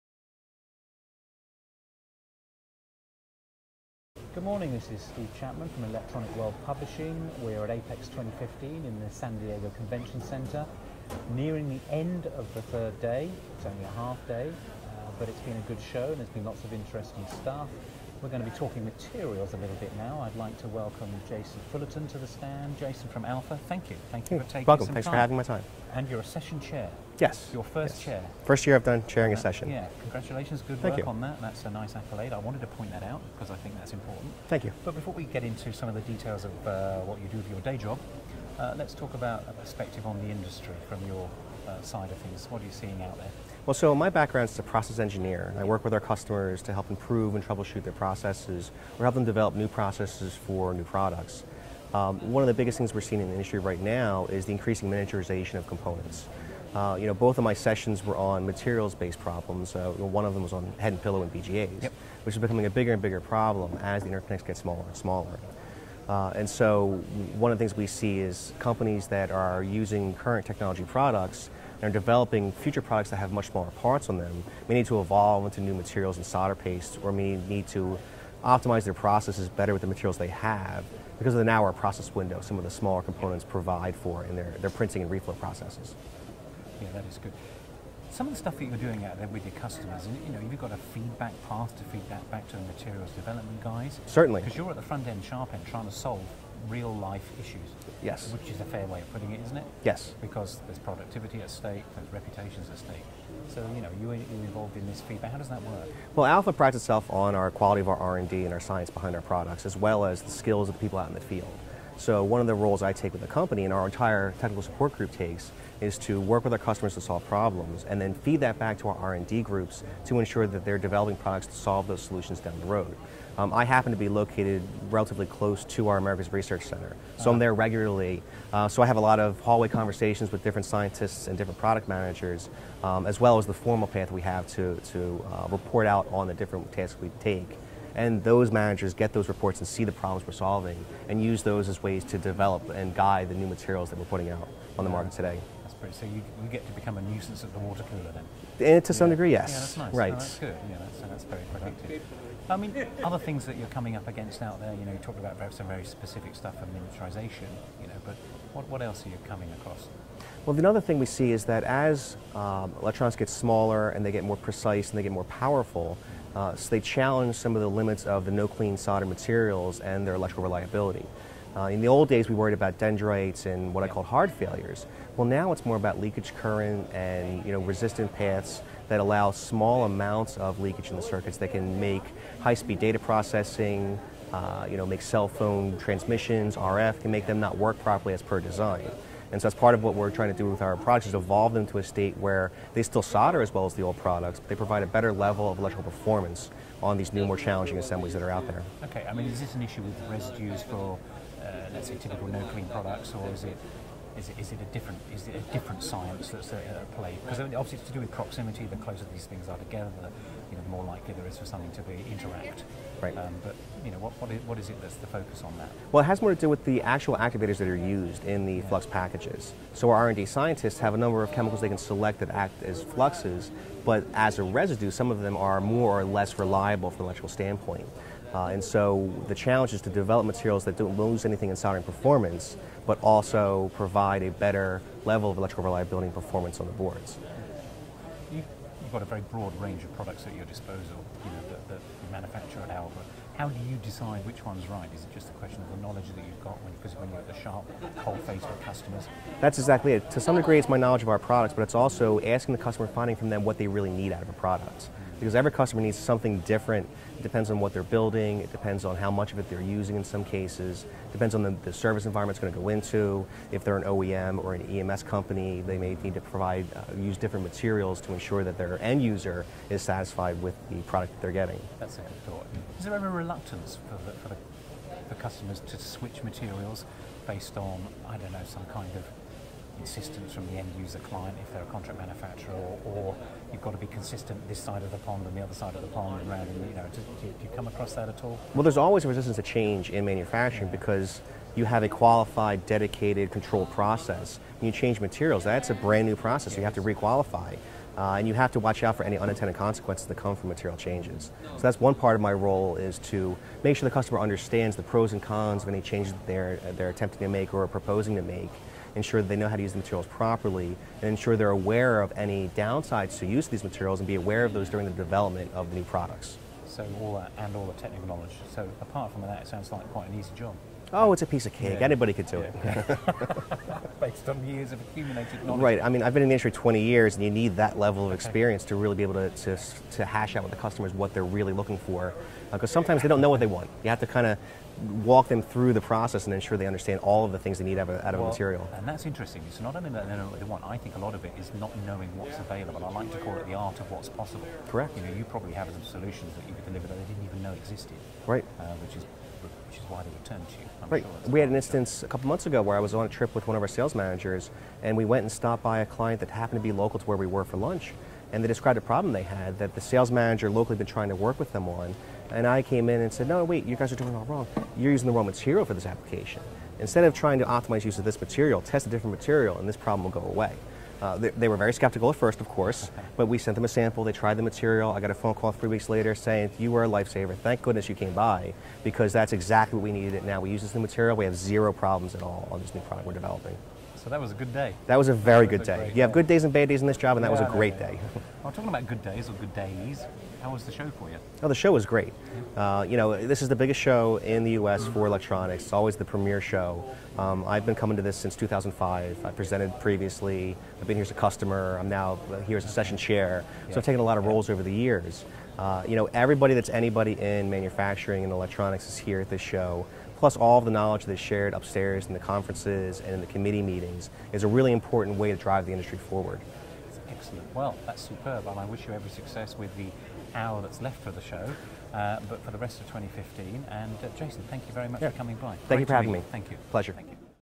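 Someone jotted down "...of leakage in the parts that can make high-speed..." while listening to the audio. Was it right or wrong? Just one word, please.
wrong.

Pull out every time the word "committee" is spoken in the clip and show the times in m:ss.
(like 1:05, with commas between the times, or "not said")
6:53.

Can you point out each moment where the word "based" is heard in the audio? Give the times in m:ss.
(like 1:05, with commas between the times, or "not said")
0:58, 4:37, 5:23.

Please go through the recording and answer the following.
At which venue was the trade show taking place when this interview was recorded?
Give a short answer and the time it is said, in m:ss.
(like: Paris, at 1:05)
San Diego Convention Center, at 0:09.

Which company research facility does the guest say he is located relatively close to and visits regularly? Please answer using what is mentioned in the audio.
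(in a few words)
America's Research Center.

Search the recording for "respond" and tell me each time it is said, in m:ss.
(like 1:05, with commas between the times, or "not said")
not said.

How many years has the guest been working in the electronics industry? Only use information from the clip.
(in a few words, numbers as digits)
20.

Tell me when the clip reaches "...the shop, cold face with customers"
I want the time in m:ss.
4:07.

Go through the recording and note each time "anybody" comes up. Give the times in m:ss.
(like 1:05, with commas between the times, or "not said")
5:21, 6:46.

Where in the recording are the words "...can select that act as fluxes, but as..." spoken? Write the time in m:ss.
3:41.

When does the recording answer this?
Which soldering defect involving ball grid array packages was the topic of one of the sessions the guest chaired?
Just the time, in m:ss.
1:00.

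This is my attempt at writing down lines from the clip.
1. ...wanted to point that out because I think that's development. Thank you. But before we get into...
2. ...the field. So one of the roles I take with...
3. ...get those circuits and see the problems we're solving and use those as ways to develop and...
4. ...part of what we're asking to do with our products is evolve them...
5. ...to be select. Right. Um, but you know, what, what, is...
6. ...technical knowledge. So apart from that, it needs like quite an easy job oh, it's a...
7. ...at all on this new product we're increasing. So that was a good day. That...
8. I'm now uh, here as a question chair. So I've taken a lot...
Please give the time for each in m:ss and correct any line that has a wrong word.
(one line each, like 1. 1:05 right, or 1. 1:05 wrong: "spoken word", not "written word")
1. 0:32 wrong: "important", not "development"
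2. 1:51 right
3. 2:18 wrong: "reports", not "circuits"
4. 3:09 wrong: "trying", not "asking"
5. 3:31 wrong: "interact", not "select"
6. 5:17 wrong: "sounds", not "needs"
7. 6:22 wrong: "developing", not "increasing"
8. 6:41 wrong: "session", not "question".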